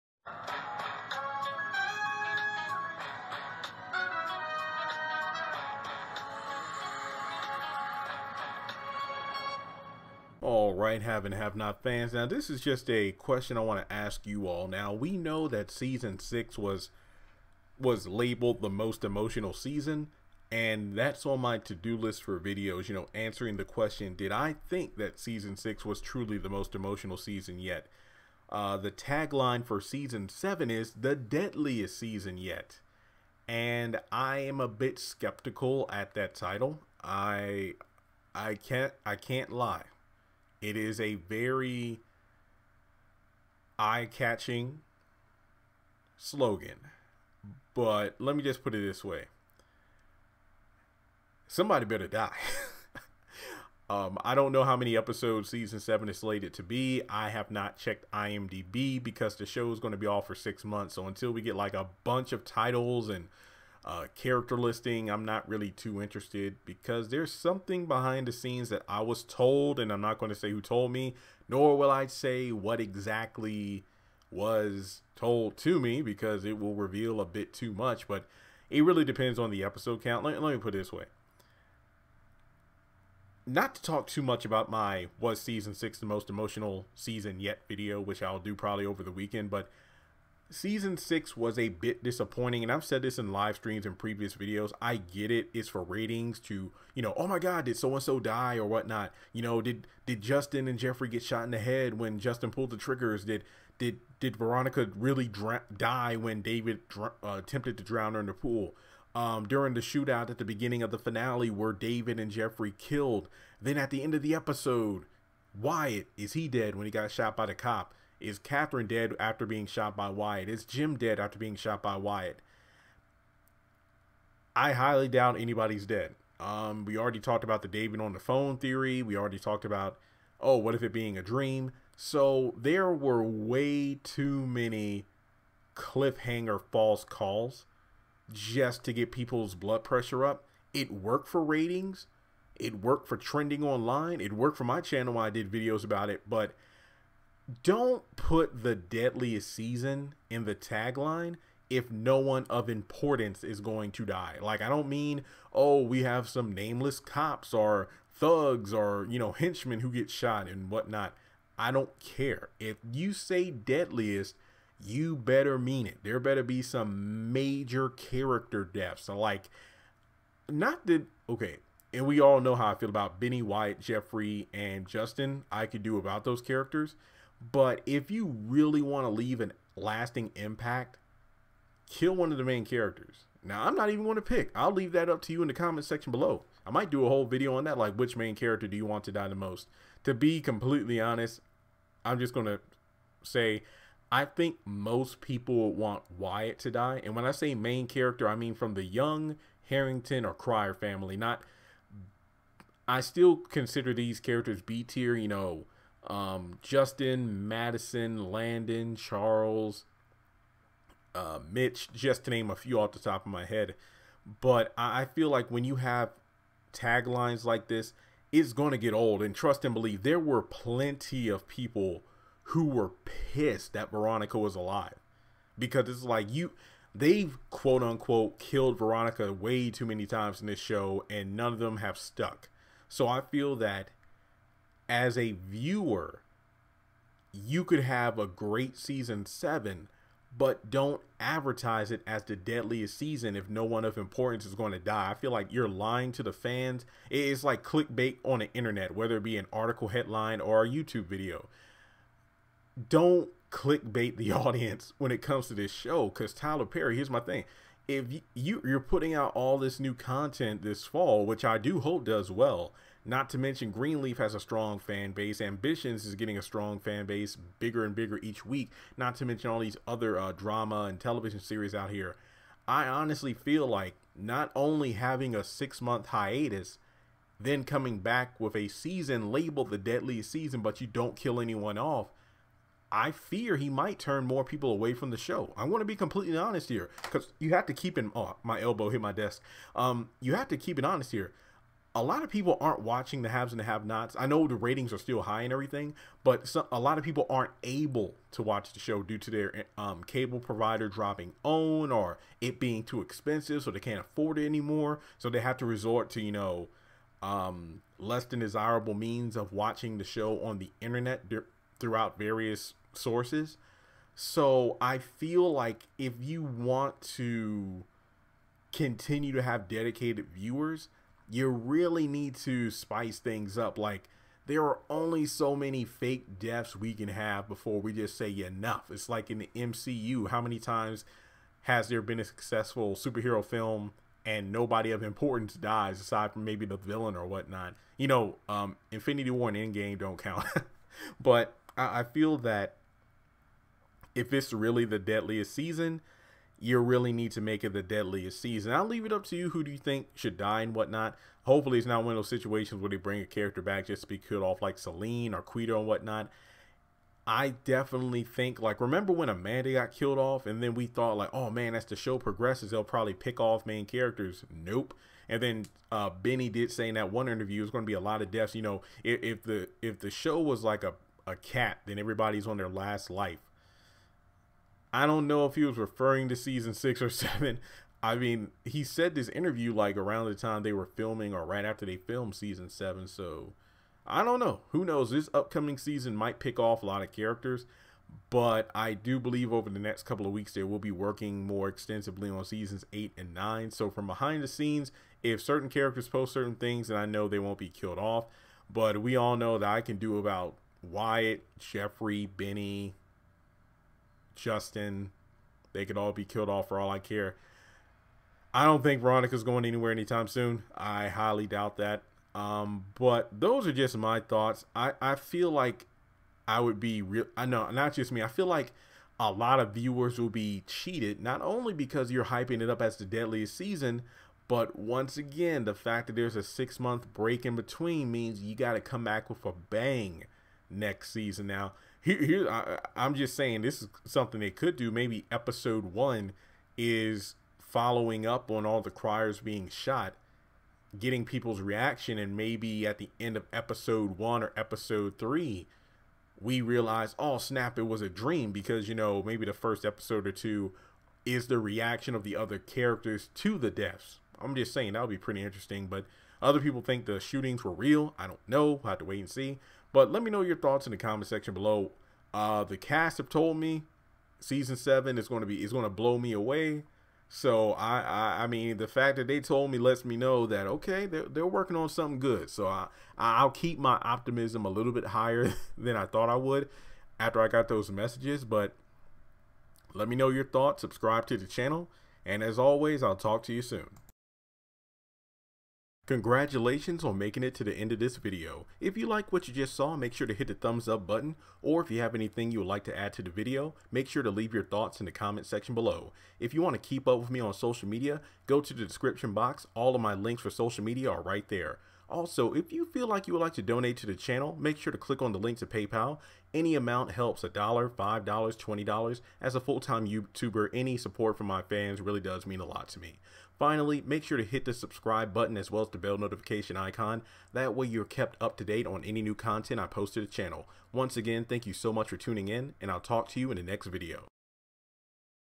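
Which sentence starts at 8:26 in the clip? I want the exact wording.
Any amount helps, a dollar, $5, $20.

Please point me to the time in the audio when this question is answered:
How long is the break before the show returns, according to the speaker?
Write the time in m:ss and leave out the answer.
1:00.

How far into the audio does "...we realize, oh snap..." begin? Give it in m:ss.
7:26.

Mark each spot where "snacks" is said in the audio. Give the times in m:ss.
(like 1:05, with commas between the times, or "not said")
not said.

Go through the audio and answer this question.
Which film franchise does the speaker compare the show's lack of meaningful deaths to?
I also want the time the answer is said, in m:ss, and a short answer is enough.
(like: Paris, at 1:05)
MCU, at 5:29.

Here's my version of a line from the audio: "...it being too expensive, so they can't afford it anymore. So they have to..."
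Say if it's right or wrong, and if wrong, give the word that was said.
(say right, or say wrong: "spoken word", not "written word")
right.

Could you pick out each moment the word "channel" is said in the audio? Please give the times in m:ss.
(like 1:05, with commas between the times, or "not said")
2:24, 8:01, 8:24, 8:40.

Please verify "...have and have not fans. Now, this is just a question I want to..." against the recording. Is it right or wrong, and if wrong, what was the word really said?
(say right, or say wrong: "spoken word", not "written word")
right.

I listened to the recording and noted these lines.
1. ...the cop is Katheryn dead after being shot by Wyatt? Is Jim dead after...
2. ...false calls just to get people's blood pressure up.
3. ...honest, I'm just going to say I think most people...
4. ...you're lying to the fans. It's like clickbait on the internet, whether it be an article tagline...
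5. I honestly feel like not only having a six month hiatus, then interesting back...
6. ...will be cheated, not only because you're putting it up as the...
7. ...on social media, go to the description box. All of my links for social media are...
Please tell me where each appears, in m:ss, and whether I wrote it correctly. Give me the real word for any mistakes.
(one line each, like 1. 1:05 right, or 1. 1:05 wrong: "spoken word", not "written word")
1. 1:57 right
2. 2:16 right
3. 3:11 right
4. 4:05 wrong: "headline", not "tagline"
5. 4:32 wrong: "coming", not "interesting"
6. 7:00 wrong: "hyping", not "putting"
7. 8:17 right.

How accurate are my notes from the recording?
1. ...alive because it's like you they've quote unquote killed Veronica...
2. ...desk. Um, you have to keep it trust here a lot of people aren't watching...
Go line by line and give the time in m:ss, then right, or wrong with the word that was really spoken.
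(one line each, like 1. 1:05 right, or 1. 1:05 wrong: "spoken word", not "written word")
1. 3:44 right
2. 4:49 wrong: "honest", not "trust".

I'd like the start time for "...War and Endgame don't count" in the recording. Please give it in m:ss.
5:39.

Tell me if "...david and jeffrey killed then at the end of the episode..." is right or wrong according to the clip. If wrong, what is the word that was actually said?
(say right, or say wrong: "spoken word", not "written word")
right.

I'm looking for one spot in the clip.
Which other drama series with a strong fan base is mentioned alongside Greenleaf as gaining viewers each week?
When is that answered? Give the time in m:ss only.
4:25.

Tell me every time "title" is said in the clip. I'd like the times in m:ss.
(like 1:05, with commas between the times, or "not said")
0:36, 1:02.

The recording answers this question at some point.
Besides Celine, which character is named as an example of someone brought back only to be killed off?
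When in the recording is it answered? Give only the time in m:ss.
5:55.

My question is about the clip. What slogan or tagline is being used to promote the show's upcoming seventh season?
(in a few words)
The deadliest season yet.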